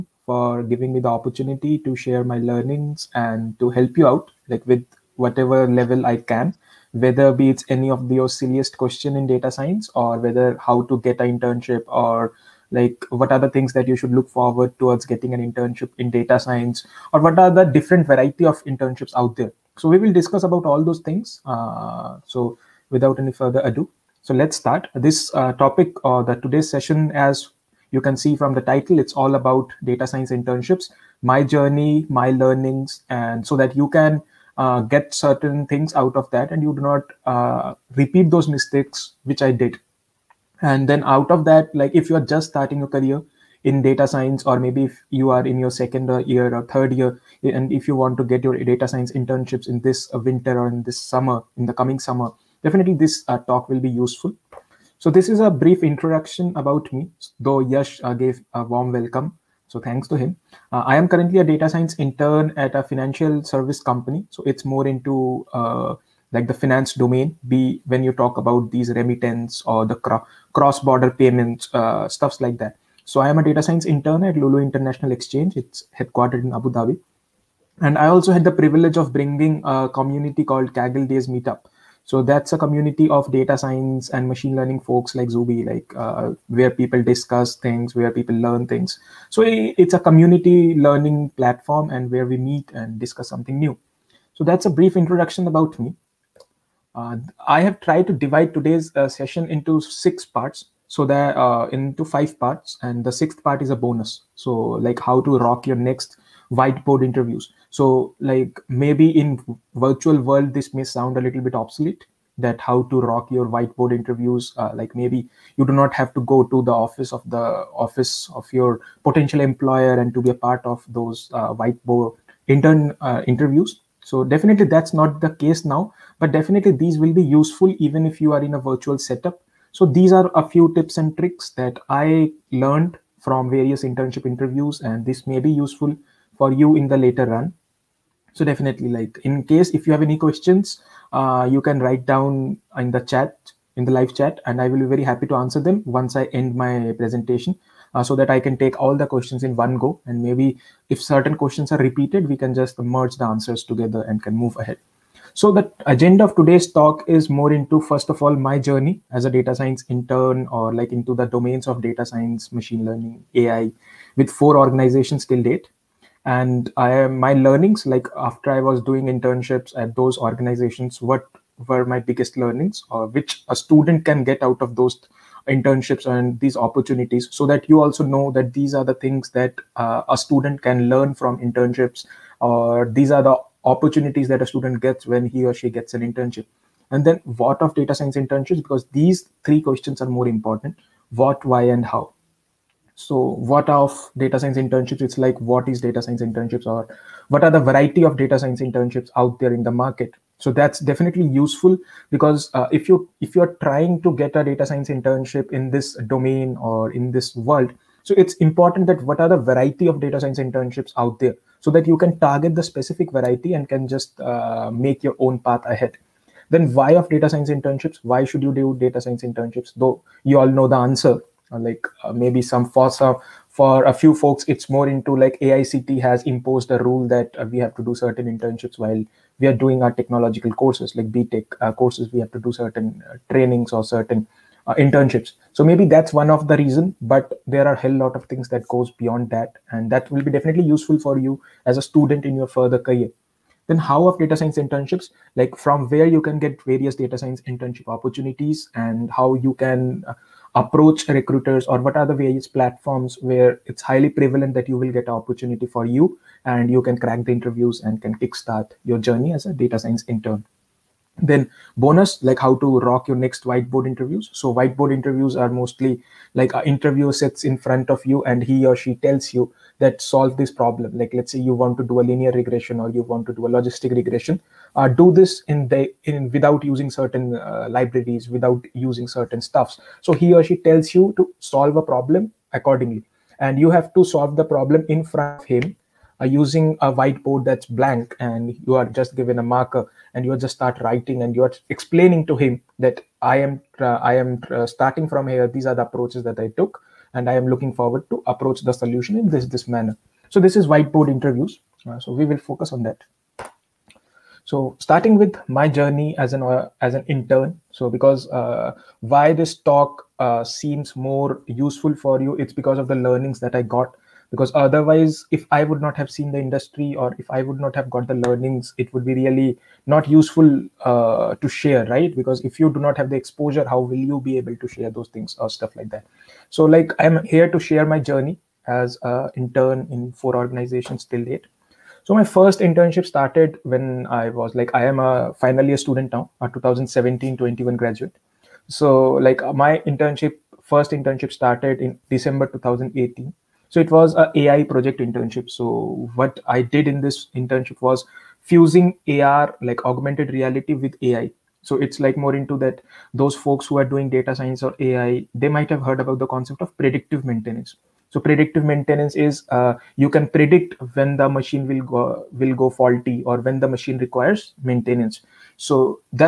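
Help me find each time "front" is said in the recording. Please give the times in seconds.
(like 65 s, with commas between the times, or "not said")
267 s, 285 s.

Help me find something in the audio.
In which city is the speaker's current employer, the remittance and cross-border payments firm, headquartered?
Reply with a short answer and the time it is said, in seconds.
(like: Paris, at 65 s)
Abu Dhabi, at 76 s.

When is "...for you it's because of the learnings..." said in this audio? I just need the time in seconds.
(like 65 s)
311 s.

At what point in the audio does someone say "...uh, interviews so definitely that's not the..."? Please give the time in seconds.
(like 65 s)
123 s.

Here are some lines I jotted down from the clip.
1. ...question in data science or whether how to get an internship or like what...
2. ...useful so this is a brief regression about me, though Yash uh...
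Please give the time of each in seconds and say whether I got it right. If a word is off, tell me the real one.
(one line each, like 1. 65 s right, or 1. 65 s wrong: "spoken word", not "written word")
1. 8 s right
2. 53 s wrong: "introduction", not "regression".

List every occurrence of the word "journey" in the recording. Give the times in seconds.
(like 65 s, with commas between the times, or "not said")
31 s, 158 s, 258 s, 305 s, 327 s.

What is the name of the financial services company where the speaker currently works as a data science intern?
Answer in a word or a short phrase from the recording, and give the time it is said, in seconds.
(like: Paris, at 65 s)
Lulu International Exchange, at 74 s.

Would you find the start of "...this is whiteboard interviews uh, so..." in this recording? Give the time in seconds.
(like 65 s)
300 s.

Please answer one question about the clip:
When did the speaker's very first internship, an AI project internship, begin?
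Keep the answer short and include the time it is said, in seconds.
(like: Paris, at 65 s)
December 2018, at 342 s.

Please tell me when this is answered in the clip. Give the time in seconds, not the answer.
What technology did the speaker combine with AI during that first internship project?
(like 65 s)
349 s.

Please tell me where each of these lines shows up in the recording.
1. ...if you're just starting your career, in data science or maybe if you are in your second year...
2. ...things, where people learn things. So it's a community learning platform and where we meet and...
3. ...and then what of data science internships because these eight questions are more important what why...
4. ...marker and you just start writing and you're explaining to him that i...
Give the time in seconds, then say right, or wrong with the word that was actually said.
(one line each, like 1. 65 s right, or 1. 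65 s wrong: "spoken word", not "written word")
1. 41 s right
2. 87 s right
3. 186 s wrong: "three", not "eight"
4. 289 s right.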